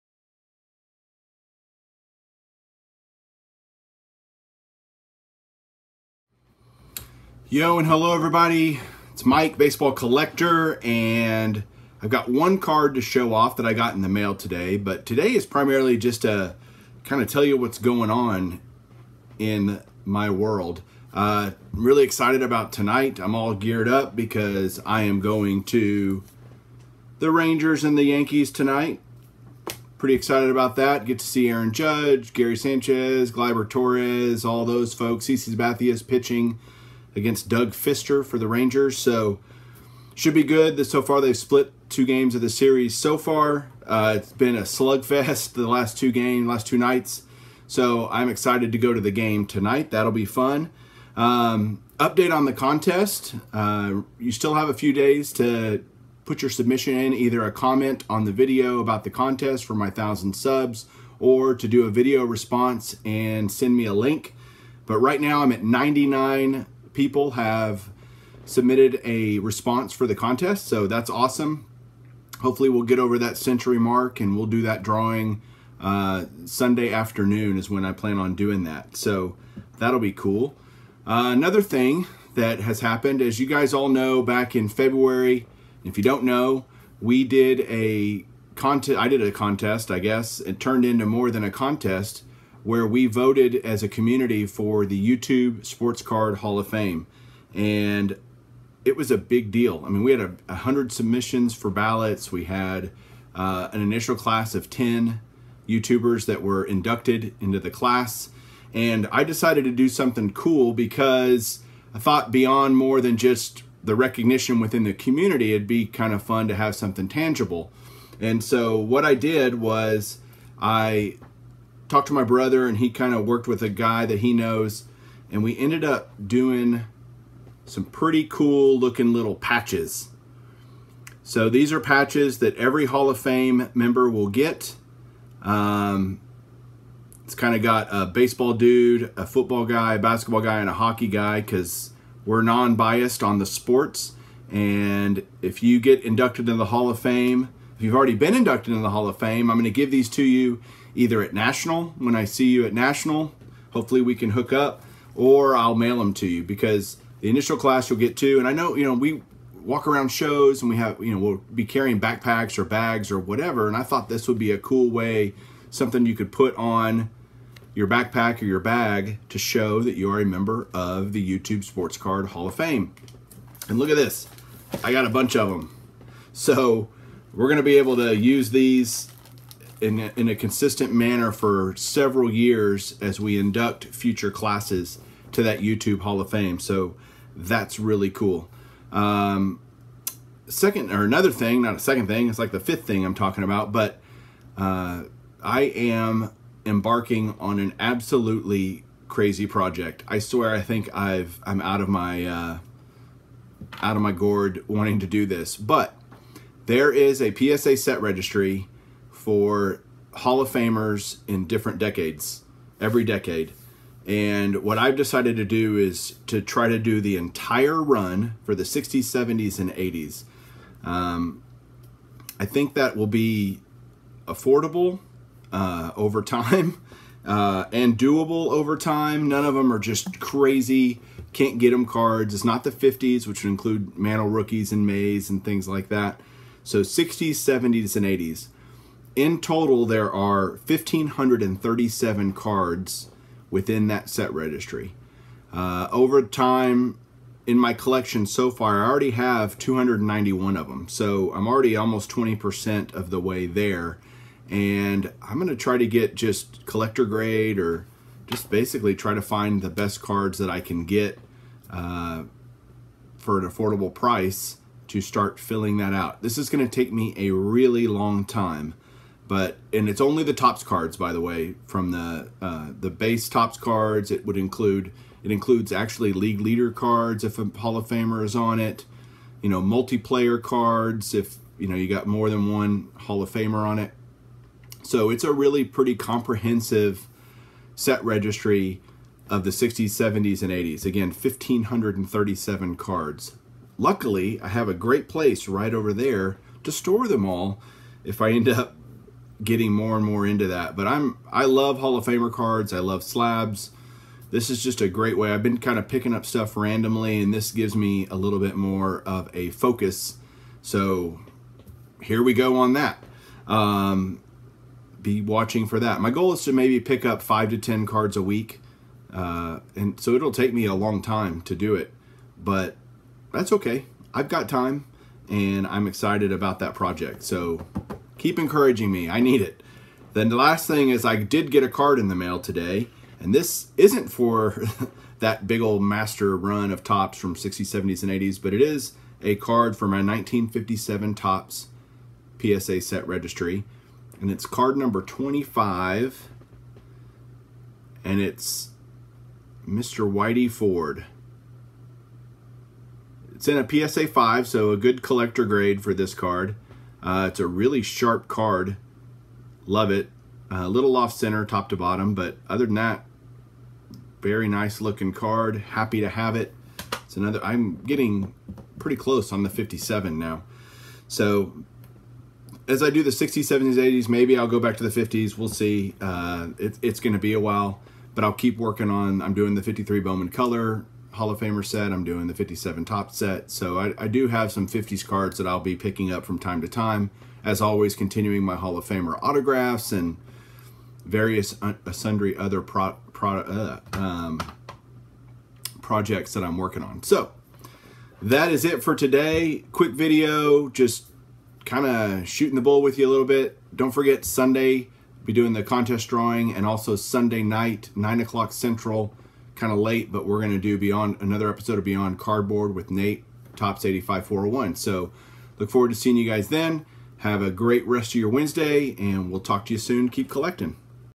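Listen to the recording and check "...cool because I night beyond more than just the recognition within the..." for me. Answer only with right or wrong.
wrong.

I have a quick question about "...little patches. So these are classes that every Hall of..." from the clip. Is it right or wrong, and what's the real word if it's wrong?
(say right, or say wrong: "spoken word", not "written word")
wrong: "patches", not "classes".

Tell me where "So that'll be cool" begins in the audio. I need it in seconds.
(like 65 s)
78 s.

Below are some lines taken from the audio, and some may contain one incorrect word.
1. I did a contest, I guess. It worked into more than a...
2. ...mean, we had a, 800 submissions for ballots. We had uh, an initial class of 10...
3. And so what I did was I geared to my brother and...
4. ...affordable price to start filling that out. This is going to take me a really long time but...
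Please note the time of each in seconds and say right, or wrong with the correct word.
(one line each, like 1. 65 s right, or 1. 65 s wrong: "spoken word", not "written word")
1. 88 s wrong: "turned", not "worked"
2. 99 s wrong: "100", not "800"
3. 118 s wrong: "talked", not "geared"
4. 263 s right.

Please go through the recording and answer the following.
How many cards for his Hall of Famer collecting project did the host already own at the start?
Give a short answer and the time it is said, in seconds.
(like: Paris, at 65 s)
291, at 249 s.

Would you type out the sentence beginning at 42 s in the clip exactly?
So far, uh, it's been a slugfest the last two games, last two nights.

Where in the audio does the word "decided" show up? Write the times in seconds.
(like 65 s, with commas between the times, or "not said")
109 s, 214 s.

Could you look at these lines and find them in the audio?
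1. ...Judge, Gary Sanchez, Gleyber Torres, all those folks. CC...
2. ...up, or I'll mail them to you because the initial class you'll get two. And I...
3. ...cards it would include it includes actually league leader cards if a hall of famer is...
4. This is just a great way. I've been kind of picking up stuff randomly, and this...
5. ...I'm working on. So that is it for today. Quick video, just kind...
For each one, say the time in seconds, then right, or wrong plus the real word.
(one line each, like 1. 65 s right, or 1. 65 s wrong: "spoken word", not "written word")
1. 31 s right
2. 154 s right
3. 273 s right
4. 304 s right
5. 396 s right.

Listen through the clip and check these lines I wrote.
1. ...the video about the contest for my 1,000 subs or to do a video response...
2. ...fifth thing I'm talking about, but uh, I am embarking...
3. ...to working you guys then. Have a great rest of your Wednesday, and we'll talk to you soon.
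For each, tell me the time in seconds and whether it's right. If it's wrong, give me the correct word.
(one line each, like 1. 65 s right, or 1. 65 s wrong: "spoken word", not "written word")
1. 58 s right
2. 192 s right
3. 415 s wrong: "seeing", not "working".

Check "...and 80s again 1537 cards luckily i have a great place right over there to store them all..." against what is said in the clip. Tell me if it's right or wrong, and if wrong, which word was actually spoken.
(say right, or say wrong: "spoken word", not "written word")
right.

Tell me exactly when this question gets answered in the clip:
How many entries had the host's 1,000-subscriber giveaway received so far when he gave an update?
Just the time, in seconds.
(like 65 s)
65 s.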